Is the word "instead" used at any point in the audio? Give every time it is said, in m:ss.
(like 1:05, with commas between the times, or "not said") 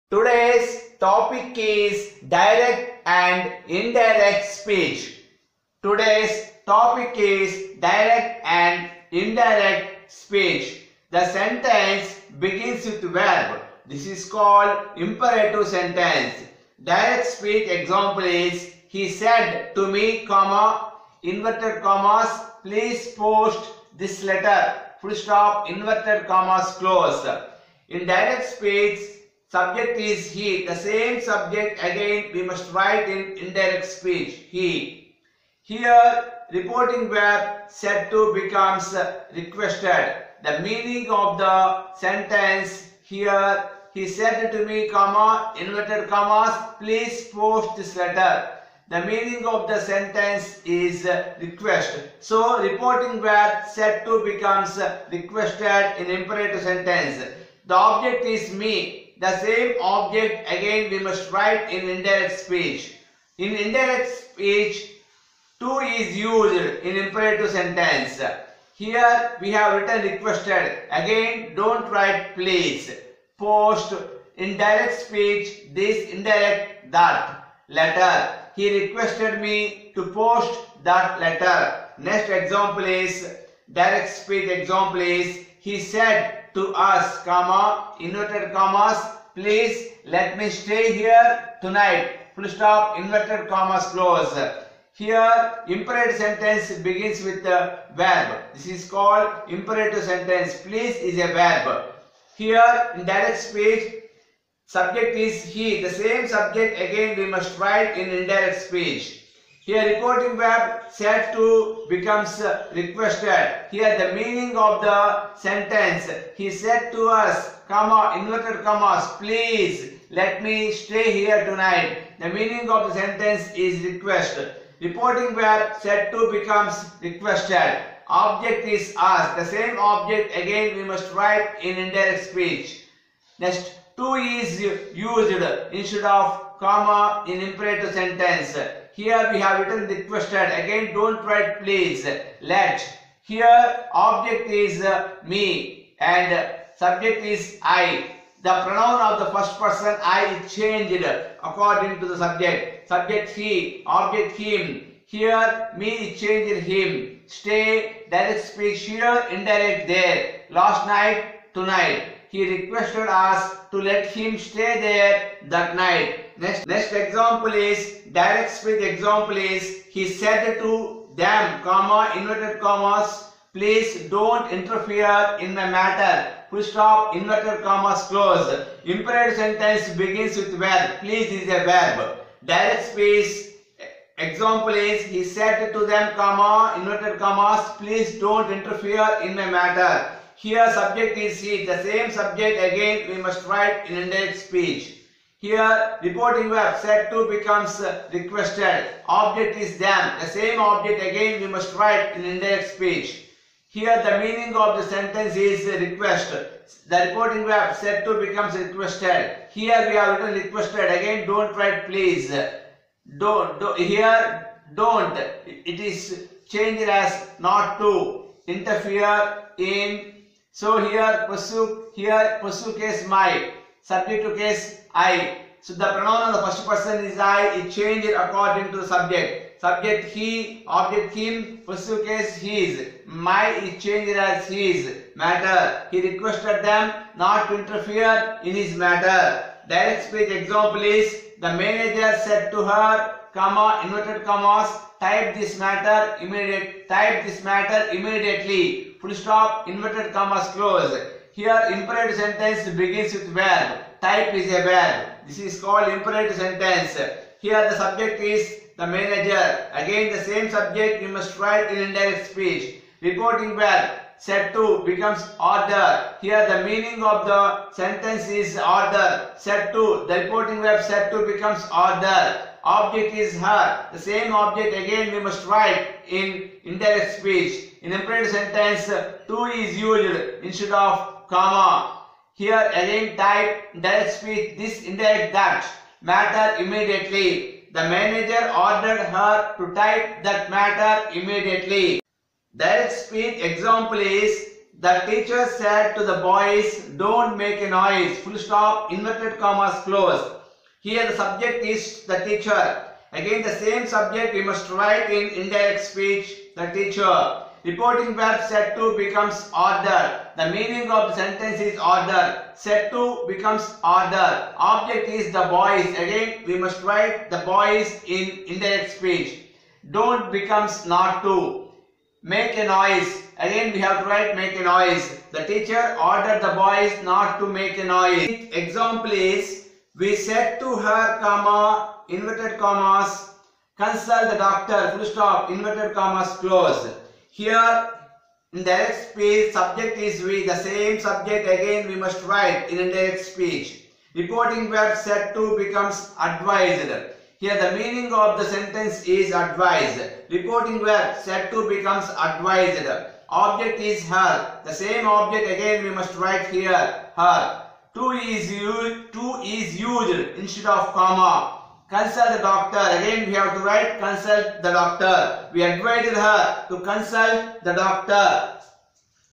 2:15, 4:40, 6:00.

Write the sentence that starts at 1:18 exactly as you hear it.
He requested me to post that letter.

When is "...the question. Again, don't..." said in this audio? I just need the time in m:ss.
2:19.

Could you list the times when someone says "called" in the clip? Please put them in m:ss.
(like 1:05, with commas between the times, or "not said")
0:14, 1:38, 4:15.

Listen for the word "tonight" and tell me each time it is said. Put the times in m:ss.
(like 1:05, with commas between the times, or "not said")
1:31, 2:01, 2:41.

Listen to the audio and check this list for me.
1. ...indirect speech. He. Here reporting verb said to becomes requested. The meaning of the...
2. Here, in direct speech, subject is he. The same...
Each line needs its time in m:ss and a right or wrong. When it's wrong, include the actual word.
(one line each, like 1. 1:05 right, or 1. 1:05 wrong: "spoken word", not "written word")
1. 0:33 right
2. 1:42 right.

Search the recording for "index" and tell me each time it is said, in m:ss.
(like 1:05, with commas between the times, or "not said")
3:13, 3:22.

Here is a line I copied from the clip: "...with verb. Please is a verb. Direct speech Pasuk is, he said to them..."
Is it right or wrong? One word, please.
wrong.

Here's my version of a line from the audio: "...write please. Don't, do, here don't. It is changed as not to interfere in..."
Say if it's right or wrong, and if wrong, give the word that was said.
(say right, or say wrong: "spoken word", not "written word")
right.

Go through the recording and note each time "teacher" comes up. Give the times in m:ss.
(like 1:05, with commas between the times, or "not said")
4:55, 5:02, 5:06, 5:25.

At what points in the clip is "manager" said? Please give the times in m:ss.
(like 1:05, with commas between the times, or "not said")
4:01, 4:18, 4:47.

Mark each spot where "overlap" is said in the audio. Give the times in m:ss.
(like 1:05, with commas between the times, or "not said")
not said.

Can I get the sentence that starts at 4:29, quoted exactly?
Set to, the reporting verb set to becomes order.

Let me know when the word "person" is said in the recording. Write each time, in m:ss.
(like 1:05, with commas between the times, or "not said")
2:29, 3:46.